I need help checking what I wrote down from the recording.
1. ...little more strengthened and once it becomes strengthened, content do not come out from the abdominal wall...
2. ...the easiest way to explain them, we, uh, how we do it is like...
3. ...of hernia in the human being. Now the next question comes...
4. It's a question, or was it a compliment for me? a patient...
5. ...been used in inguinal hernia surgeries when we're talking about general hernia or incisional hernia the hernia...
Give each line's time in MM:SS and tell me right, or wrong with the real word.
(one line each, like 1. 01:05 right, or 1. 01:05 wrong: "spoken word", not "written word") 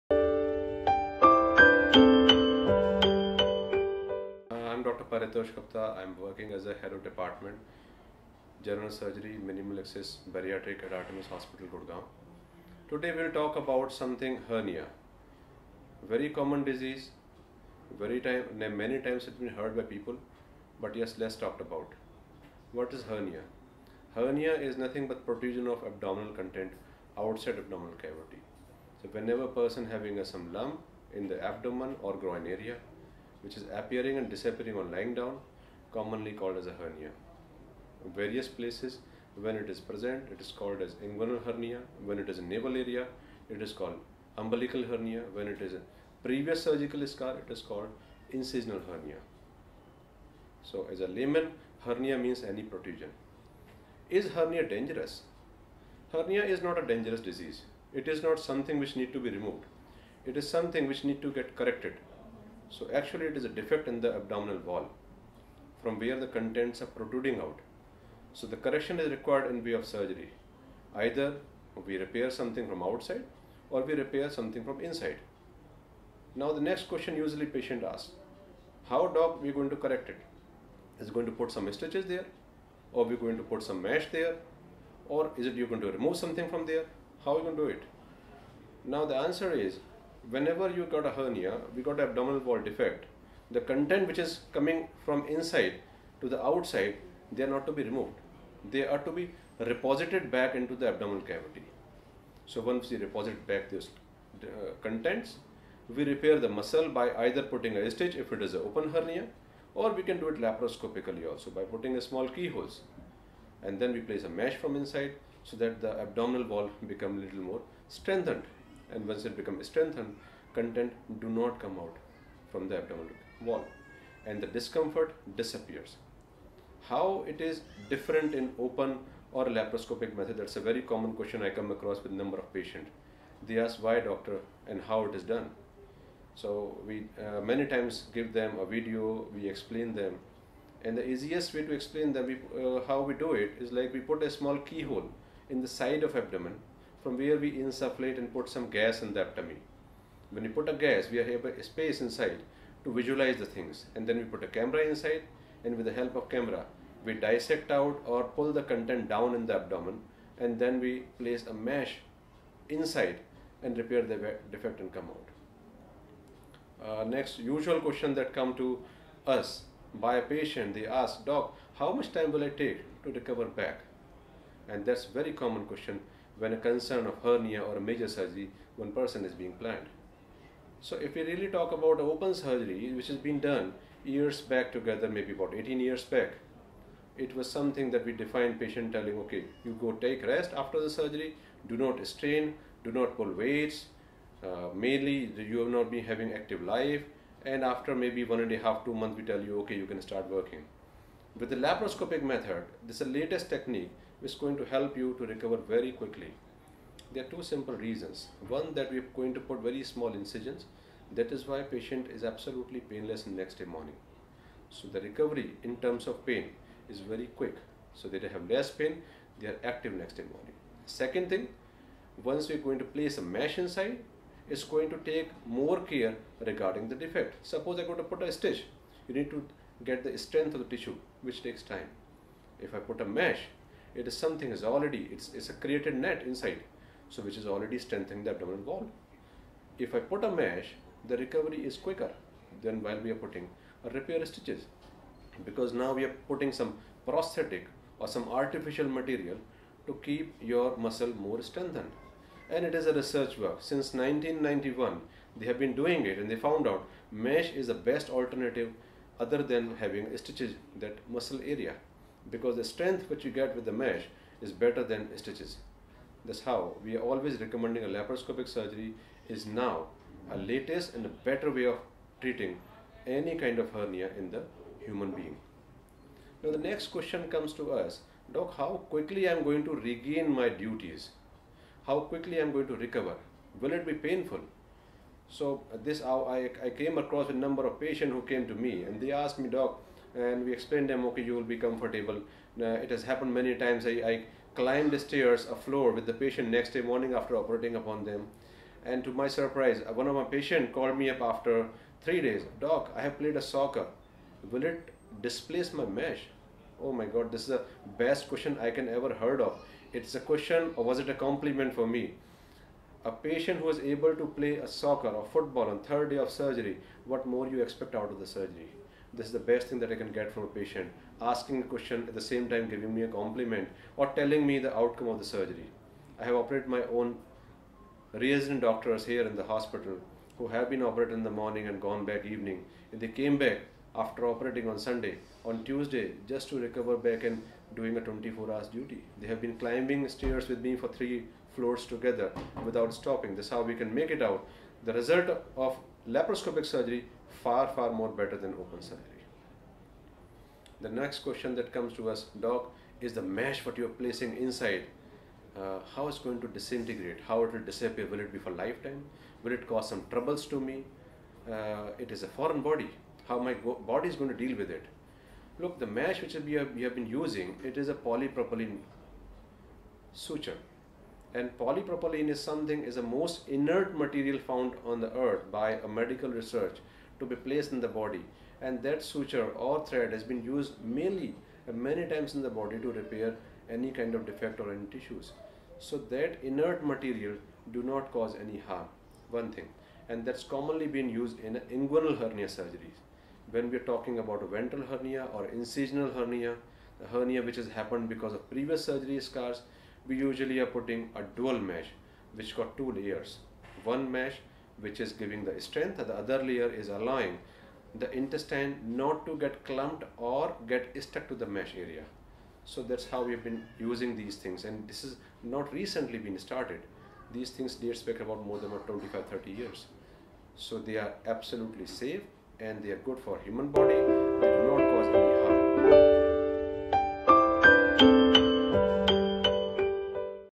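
1. 01:57 right
2. 02:20 right
3. 04:33 right
4. 05:09 right
5. 06:30 wrong: "ventral", not "general".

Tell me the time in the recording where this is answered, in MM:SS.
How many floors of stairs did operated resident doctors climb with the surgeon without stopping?
05:40.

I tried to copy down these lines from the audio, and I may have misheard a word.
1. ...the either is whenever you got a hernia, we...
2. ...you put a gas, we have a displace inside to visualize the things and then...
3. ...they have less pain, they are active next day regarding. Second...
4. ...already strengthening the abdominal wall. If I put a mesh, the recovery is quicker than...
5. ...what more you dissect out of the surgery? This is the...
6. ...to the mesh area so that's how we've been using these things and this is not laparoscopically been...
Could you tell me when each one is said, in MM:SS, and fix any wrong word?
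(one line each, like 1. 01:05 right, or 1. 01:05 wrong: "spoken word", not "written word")
1. 01:29 wrong: "answer", not "either"
2. 02:30 wrong: "space", not "displace"
3. 03:38 wrong: "morning", not "regarding"
4. 03:57 right
5. 05:17 wrong: "expect", not "dissect"
6. 06:51 wrong: "recently", not "laparoscopically".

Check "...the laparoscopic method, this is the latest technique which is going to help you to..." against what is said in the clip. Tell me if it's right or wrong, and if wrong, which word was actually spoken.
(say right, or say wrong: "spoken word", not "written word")
right.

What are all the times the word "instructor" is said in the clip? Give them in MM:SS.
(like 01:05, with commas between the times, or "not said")
not said.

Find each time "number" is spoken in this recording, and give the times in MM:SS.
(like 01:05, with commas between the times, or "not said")
02:12, 04:47.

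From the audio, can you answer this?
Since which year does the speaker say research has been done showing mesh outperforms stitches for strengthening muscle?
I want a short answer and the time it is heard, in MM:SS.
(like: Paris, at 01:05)
1991, at 04:13.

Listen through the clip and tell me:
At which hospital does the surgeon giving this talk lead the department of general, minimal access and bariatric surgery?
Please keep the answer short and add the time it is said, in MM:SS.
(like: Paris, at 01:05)
Artemis Hospital, at 00:10.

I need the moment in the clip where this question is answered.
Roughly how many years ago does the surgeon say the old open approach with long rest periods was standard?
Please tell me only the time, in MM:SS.
03:05.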